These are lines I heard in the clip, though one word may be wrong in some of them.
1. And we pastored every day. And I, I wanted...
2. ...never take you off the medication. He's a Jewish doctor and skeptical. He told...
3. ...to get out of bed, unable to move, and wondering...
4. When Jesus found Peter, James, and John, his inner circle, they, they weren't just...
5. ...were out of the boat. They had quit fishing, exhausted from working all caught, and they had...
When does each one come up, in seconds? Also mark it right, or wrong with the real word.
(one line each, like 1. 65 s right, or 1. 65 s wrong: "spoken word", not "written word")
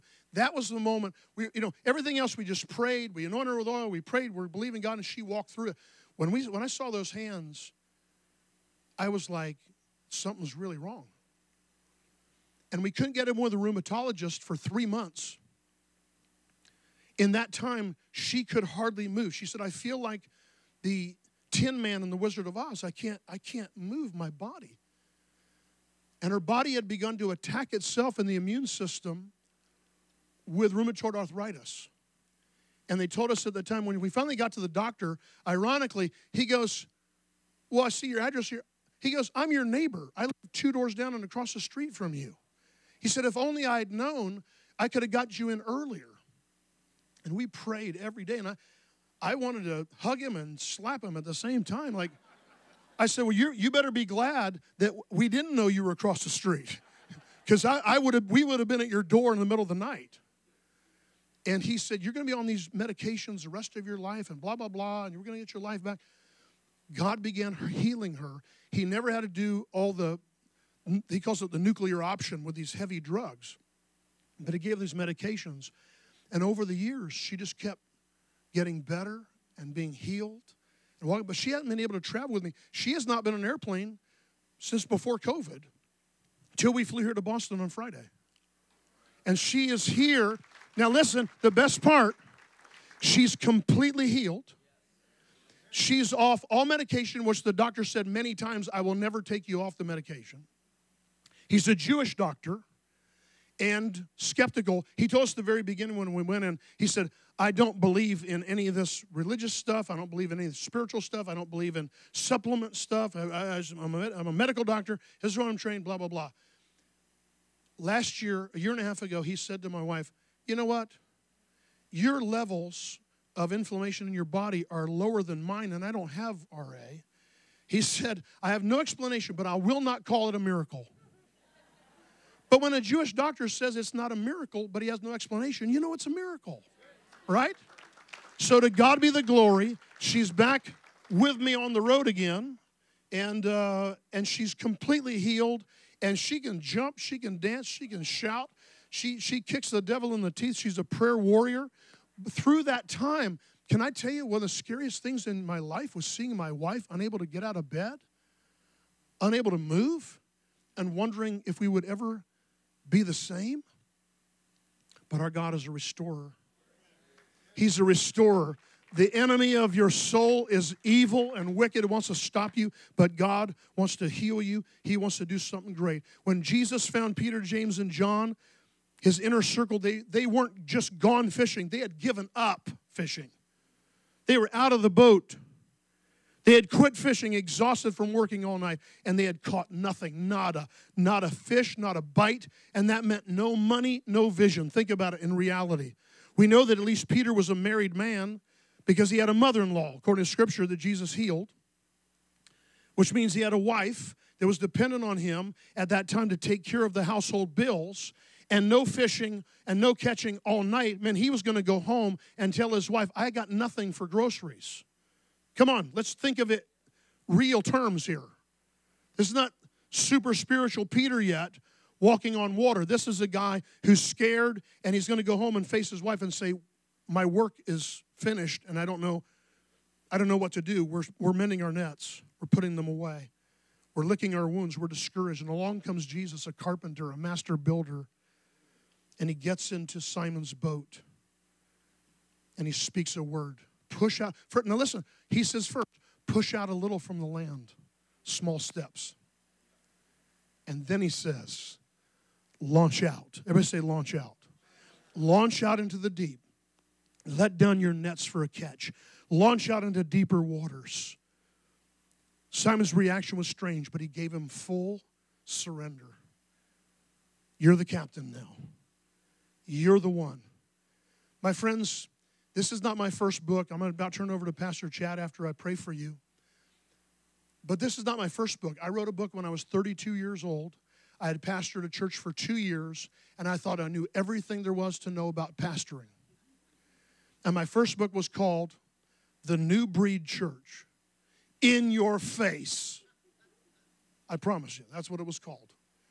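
1. 47 s wrong: "prayed", not "pastored"
2. 98 s right
3. 157 s right
4. 176 s right
5. 184 s wrong: "night", not "caught".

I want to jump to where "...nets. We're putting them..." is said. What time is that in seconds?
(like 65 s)
231 s.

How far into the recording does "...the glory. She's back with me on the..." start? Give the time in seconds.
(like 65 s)
139 s.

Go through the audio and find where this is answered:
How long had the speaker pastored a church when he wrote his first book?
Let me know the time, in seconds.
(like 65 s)
282 s.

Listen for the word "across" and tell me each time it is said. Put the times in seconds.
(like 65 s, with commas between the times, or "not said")
41 s, 55 s.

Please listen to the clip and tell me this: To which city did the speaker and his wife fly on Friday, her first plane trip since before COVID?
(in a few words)
Boston.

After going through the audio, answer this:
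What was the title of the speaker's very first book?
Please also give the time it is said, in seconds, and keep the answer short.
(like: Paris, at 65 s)
The New Breed Church In Your Face, at 289 s.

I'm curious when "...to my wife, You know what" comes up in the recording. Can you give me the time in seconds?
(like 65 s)
119 s.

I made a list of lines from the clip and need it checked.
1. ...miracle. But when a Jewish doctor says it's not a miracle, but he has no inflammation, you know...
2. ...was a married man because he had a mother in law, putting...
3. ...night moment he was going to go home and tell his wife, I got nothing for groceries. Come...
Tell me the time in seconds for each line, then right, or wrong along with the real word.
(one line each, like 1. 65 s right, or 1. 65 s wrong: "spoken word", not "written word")
1. 130 s wrong: "explanation", not "inflammation"
2. 197 s wrong: "according", not "putting"
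3. 210 s wrong: "meant", not "moment".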